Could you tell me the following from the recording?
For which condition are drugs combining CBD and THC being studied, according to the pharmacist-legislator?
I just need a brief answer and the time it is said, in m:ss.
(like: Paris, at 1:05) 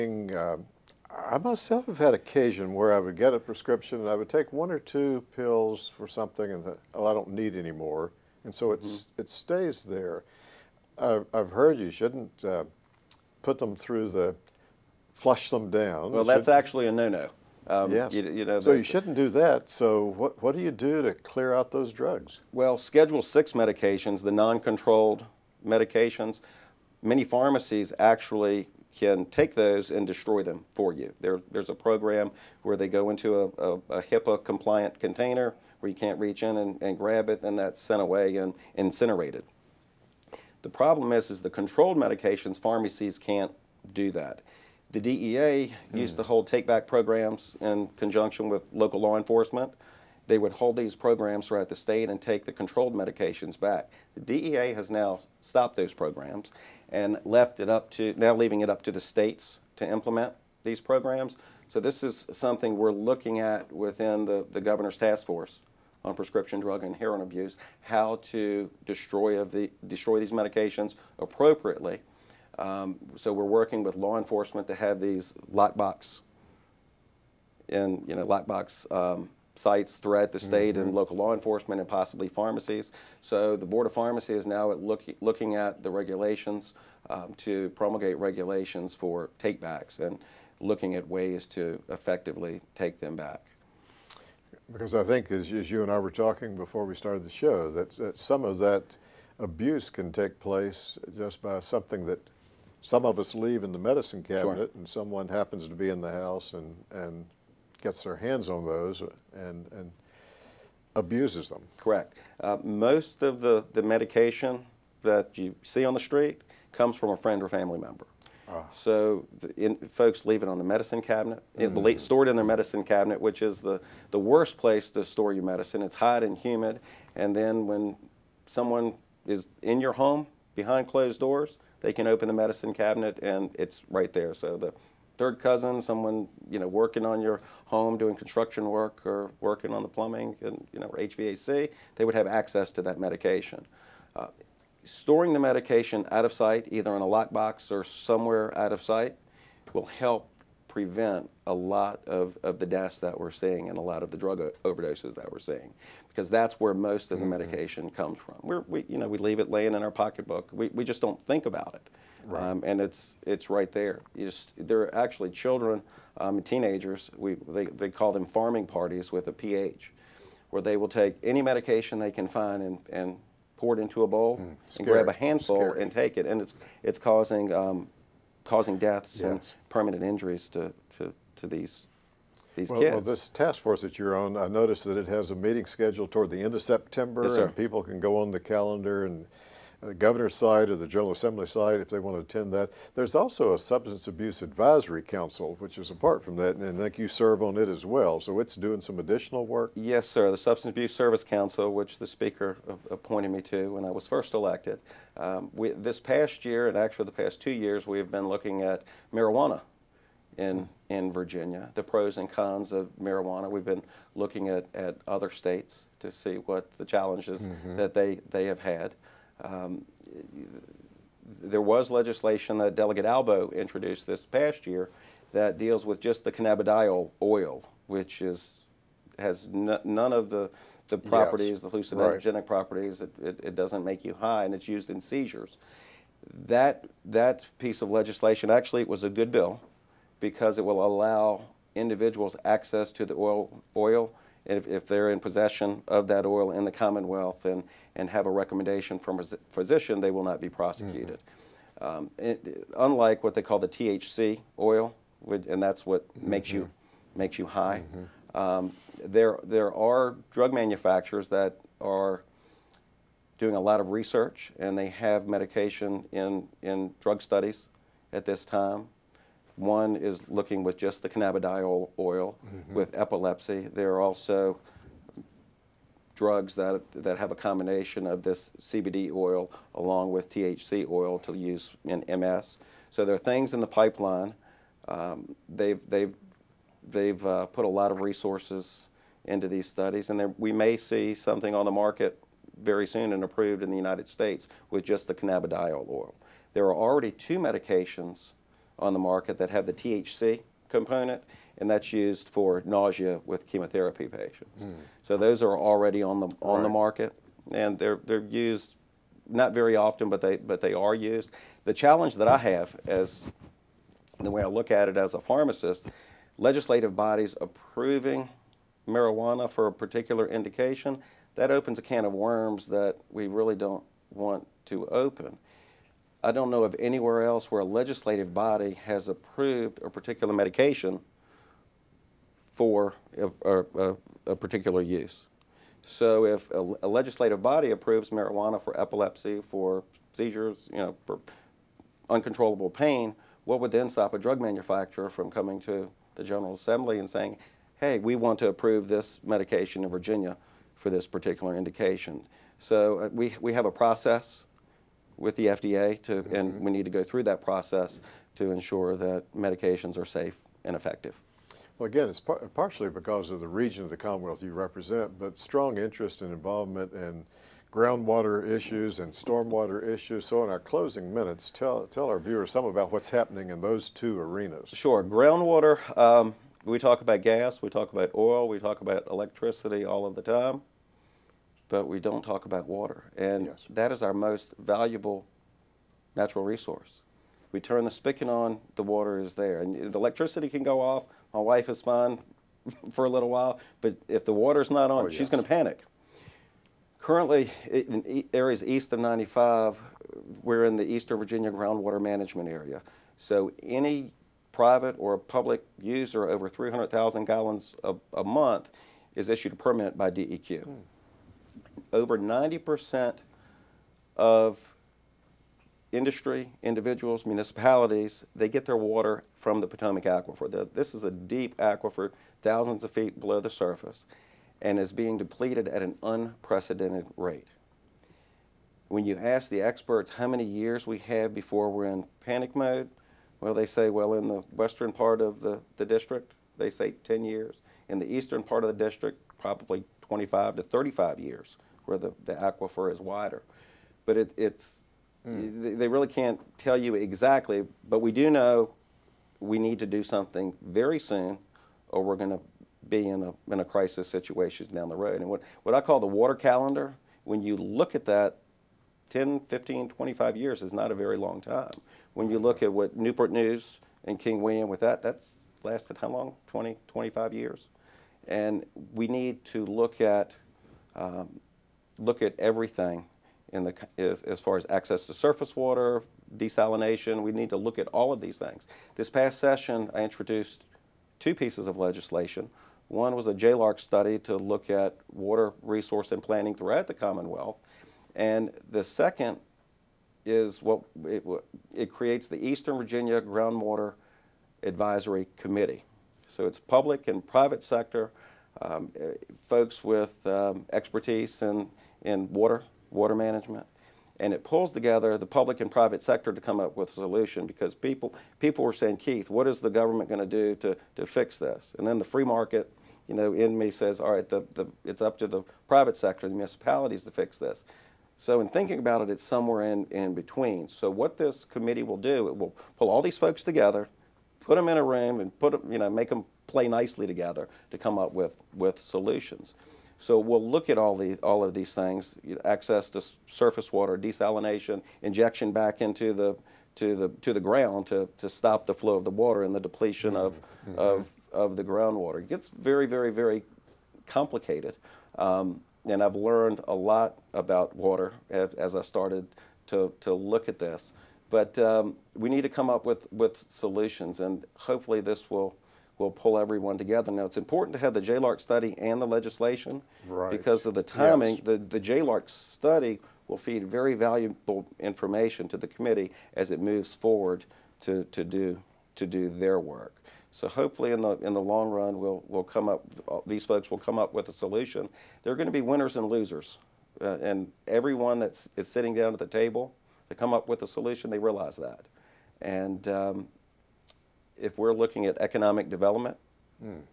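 MS, at 4:42.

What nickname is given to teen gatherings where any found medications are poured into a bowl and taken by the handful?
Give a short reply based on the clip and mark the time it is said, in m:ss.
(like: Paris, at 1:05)
pharming parties, at 2:48.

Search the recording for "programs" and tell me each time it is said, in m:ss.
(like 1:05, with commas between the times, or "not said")
0:31, 0:46, 0:50, 0:55, 1:00.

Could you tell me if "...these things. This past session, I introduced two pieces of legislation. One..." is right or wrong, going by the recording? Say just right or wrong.
right.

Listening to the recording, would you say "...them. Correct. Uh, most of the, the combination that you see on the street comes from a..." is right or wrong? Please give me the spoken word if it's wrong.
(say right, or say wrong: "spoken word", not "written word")
wrong: "medication", not "combination".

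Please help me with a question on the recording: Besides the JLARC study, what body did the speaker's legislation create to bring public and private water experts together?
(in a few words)
Eastern Virginia Groundwater Advisory Committee.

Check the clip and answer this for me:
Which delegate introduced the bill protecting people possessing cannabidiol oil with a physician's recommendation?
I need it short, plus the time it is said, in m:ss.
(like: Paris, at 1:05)
Delegate Albo, at 3:42.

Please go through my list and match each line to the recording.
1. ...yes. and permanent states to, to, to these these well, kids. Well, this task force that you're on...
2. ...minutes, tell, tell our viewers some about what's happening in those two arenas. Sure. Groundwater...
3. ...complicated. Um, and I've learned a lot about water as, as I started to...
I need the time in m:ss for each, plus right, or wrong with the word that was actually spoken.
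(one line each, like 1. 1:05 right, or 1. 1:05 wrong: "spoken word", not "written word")
1. 2:59 wrong: "injuries", not "states"
2. 6:11 right
3. 9:04 right.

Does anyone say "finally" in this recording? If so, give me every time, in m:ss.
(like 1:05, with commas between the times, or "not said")
not said.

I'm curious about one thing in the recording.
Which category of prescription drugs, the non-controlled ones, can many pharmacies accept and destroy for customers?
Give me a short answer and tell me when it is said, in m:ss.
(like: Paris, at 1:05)
Schedule 6, at 0:22.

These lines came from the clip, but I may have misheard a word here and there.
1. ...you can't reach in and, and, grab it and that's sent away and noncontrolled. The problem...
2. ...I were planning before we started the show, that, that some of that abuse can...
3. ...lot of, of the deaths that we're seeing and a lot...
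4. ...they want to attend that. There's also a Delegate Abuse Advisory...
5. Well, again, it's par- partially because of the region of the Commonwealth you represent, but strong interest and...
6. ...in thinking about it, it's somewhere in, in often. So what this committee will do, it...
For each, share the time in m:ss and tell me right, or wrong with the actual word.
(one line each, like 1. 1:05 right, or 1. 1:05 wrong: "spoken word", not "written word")
1. 0:35 wrong: "incinerated", not "noncontrolled"
2. 1:35 wrong: "talking", not "planning"
3. 2:31 right
4. 3:11 wrong: "Substance", not "Delegate"
5. 6:01 right
6. 8:38 wrong: "between", not "often".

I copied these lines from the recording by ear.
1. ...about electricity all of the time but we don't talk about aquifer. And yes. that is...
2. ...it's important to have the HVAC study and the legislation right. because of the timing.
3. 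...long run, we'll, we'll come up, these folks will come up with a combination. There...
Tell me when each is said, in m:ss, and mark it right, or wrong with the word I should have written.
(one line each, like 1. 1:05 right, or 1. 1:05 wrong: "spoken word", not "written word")
1. 6:18 wrong: "water", not "aquifer"
2. 9:17 wrong: "JLARC", not "HVAC"
3. 9:31 wrong: "solution", not "combination".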